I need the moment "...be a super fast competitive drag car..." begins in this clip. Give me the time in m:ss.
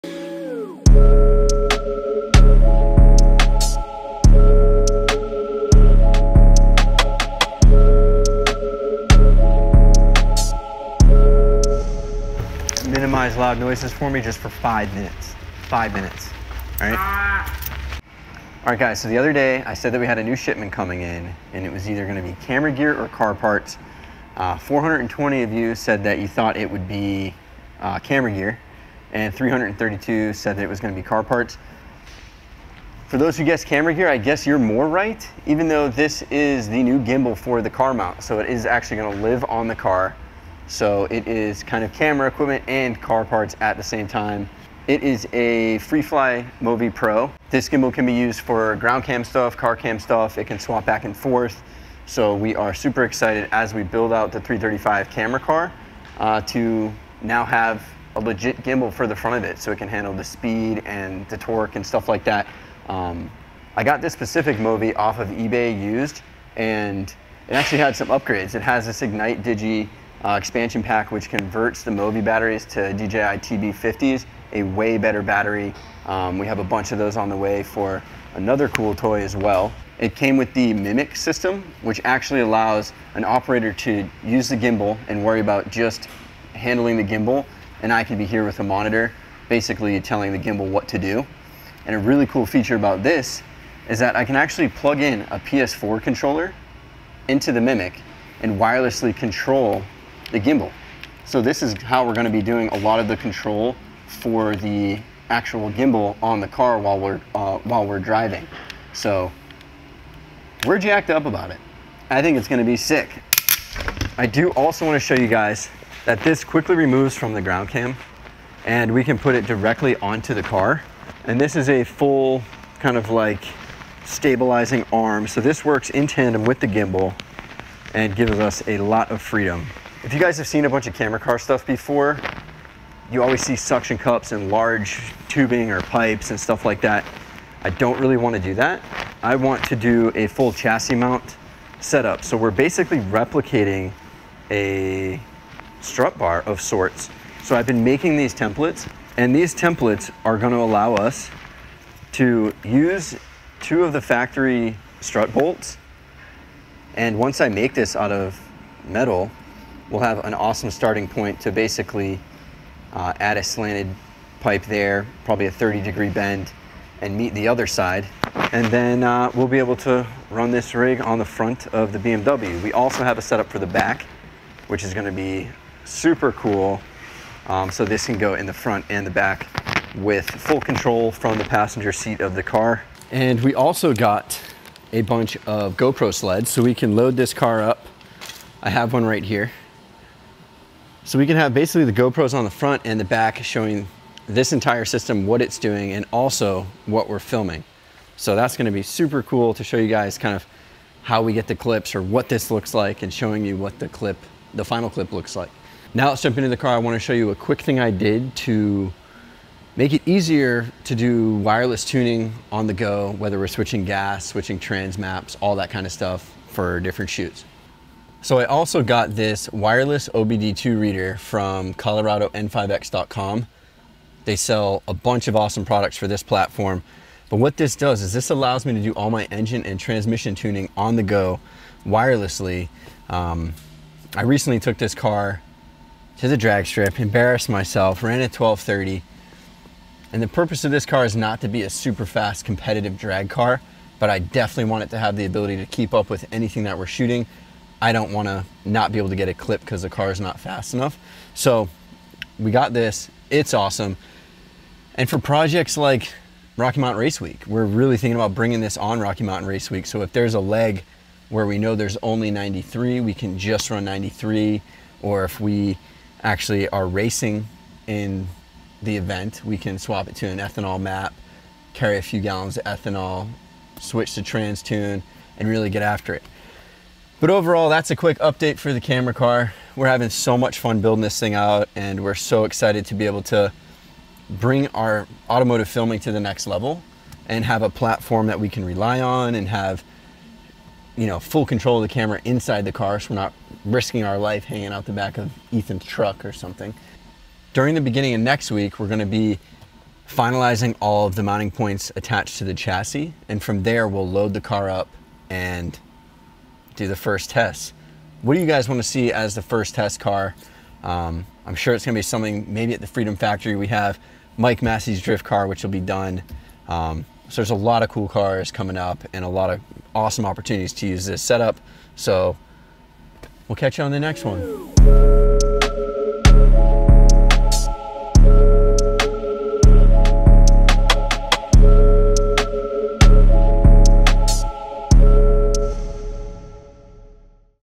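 4:01.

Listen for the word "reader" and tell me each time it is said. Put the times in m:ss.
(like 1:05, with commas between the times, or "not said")
3:40.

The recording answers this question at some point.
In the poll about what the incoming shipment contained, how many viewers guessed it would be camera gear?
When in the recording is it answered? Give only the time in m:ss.
0:24.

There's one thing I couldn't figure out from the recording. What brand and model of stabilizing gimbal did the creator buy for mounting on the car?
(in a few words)
FreeFly Movi Pro.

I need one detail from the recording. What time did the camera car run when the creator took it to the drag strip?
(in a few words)
12.30.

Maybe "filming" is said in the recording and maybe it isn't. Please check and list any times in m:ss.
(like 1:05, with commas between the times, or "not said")
3:17, 4:45.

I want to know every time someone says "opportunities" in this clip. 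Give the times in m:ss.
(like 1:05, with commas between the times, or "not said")
5:20.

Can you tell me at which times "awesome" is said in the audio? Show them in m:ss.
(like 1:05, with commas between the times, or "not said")
2:40, 3:45, 4:13, 5:19.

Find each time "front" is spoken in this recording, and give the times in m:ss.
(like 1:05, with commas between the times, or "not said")
0:59, 2:51, 2:58, 3:12.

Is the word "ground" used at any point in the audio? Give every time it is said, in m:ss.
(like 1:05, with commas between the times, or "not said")
0:48, 1:57.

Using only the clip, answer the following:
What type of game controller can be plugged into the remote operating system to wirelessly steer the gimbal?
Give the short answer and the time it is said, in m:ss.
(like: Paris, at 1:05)
PS4 controller, at 1:35.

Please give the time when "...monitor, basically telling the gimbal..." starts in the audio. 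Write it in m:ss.
1:28.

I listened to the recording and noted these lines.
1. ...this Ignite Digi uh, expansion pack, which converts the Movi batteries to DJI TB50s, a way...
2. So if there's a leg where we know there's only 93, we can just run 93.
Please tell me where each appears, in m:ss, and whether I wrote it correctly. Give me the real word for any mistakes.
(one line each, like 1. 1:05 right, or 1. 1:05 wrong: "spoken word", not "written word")
1. 1:08 right
2. 4:19 right.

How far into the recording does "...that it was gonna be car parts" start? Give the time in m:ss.
0:30.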